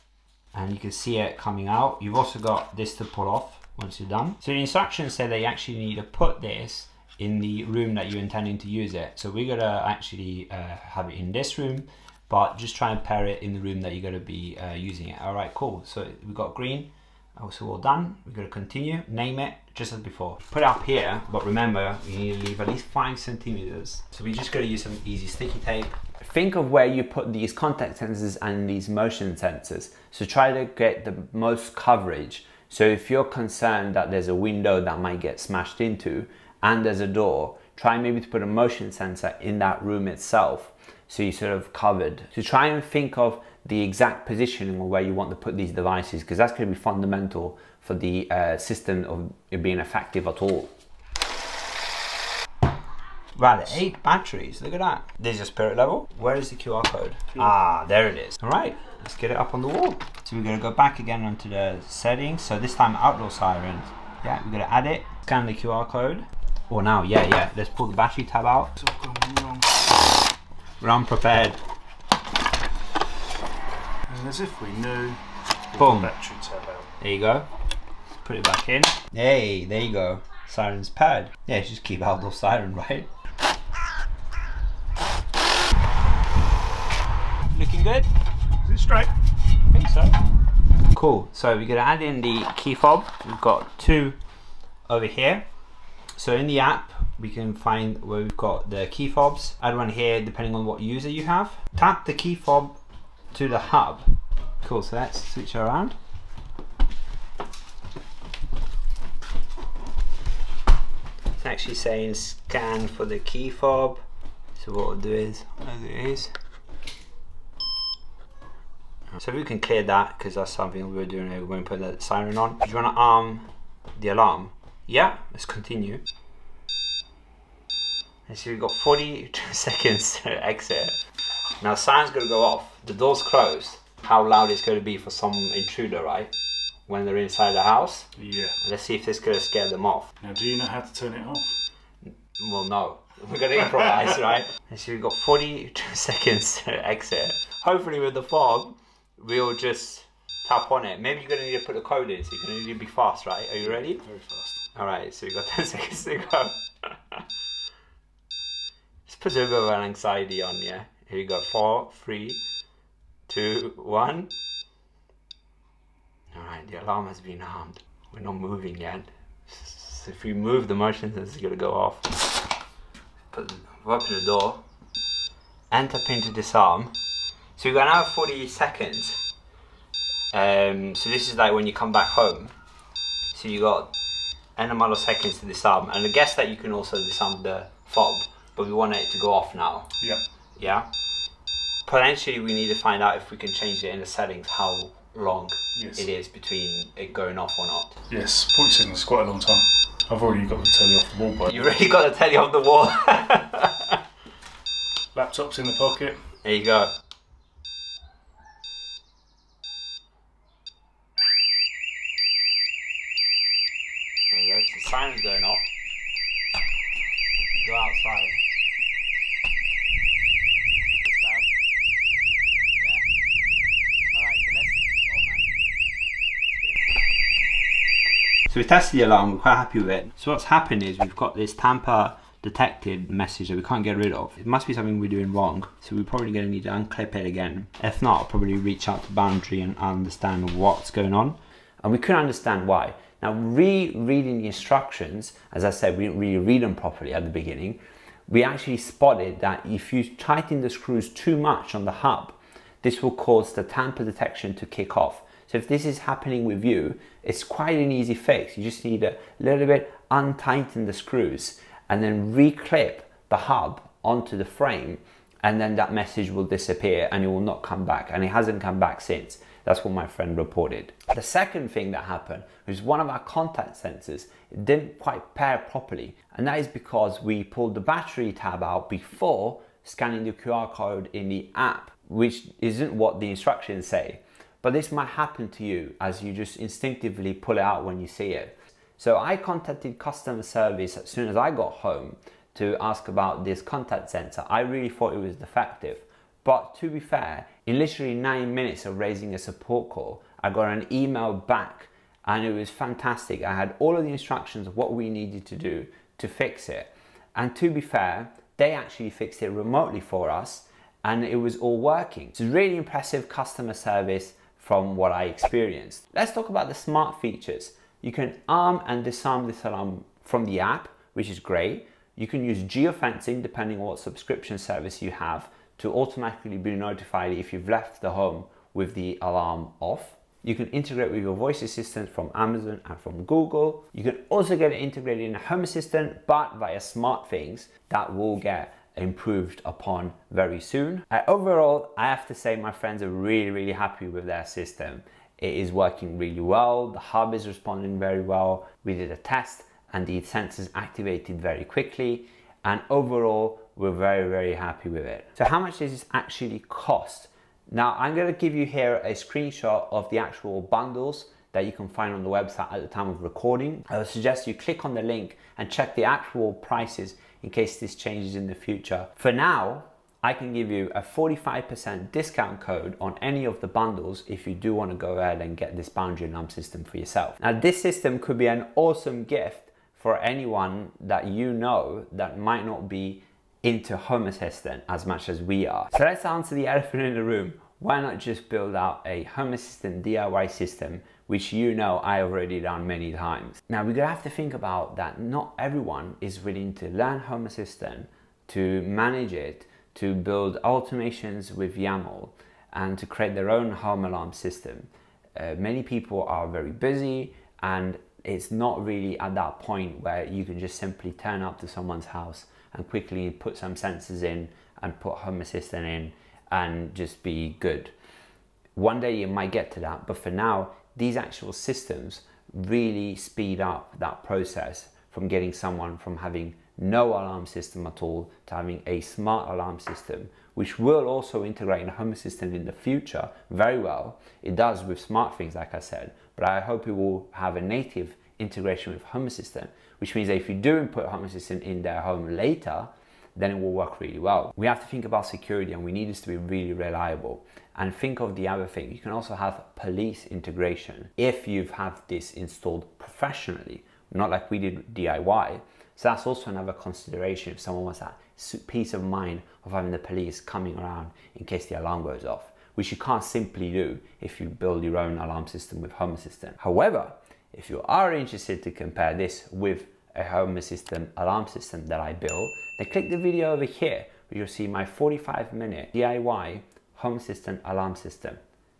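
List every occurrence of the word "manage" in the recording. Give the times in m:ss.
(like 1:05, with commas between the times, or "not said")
6:38.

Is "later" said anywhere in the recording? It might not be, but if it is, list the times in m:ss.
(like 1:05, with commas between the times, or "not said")
7:22.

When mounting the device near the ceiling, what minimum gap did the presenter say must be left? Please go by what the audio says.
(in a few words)
5 centimeters.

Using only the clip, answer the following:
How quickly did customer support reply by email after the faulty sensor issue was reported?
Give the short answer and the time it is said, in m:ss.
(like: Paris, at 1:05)
9 minutes, at 4:58.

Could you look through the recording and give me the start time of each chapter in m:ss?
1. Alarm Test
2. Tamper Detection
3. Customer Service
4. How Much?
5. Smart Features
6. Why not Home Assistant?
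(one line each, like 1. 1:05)
1. 2:01
2. 3:50
3. 4:30
4. 5:55
5. 5:14
6. 6:25.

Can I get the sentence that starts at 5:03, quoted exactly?
I had all of the instructions of what we needed to do to fix it.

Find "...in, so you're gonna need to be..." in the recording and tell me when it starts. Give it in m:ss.
2:32.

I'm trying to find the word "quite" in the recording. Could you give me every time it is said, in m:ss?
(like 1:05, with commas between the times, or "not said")
3:19, 3:49, 4:17, 4:35.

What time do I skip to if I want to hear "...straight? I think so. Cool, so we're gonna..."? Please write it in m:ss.
1:28.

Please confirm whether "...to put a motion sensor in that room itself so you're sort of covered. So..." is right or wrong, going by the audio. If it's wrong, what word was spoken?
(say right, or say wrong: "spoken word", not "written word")
right.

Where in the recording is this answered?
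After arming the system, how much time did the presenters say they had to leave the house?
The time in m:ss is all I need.
2:08.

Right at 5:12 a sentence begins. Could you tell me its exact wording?
So really impressive customer service from what I experienced.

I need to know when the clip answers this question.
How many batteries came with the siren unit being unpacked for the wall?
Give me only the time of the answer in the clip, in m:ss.
0:53.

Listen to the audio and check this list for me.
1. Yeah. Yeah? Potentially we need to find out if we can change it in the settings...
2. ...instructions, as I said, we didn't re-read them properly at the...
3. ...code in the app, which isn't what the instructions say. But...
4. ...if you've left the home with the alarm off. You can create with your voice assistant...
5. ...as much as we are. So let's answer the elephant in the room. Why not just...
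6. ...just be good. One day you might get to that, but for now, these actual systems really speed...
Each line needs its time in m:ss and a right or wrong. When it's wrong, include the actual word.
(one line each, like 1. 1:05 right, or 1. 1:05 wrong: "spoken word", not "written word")
1. 3:10 right
2. 4:04 right
3. 4:40 right
4. 5:27 wrong: "integrate", not "create"
5. 6:24 right
6. 6:56 right.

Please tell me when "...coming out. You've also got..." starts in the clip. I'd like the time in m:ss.
0:01.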